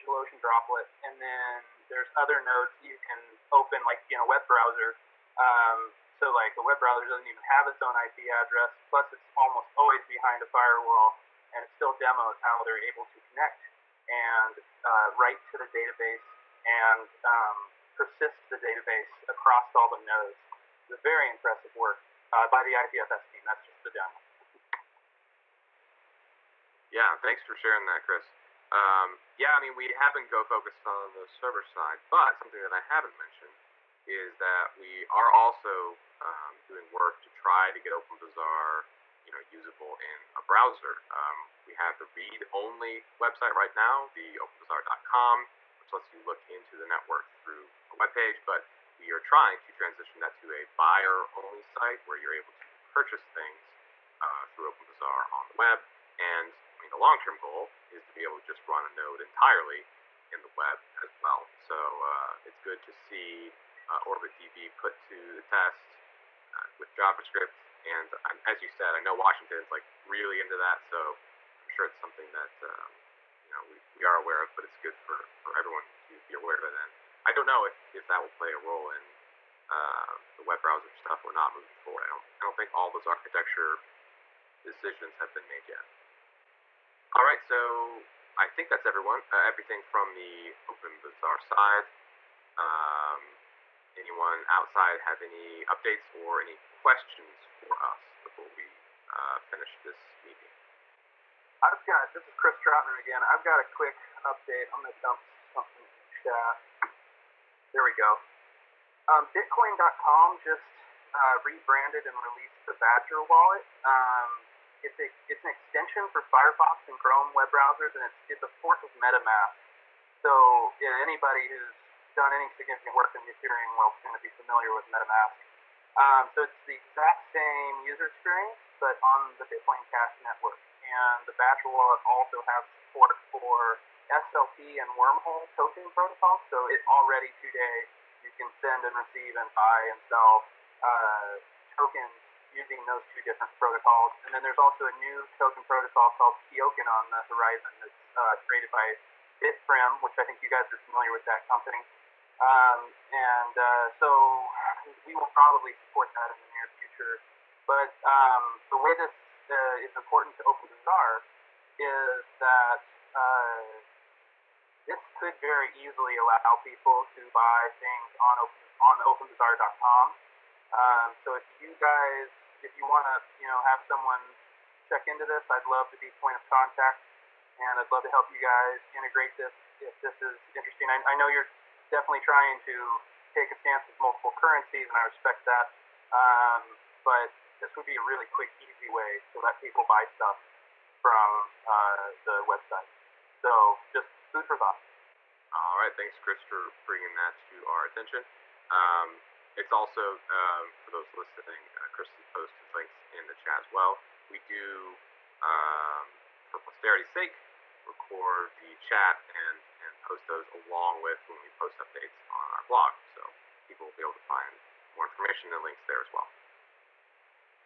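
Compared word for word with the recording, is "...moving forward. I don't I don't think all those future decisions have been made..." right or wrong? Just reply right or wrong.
wrong.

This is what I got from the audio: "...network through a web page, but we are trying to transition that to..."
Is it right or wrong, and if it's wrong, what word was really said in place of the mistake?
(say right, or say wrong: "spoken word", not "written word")
right.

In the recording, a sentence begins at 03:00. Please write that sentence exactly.
I, I know you're definitely trying to take a stance with multiple currencies, and I respect that.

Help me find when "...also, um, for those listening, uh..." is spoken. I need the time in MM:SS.
03:19.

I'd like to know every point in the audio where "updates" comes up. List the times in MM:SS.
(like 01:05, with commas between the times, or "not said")
01:35, 01:44, 03:31.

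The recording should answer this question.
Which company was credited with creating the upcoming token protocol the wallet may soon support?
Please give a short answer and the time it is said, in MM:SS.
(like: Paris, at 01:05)
Bitprim, at 02:29.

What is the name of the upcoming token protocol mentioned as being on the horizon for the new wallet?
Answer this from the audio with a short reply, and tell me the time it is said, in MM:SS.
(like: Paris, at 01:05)
Keoken, at 02:26.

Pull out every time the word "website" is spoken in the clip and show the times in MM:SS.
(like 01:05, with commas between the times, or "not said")
00:43, 03:12.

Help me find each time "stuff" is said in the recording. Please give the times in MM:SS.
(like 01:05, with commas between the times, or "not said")
01:20, 03:10.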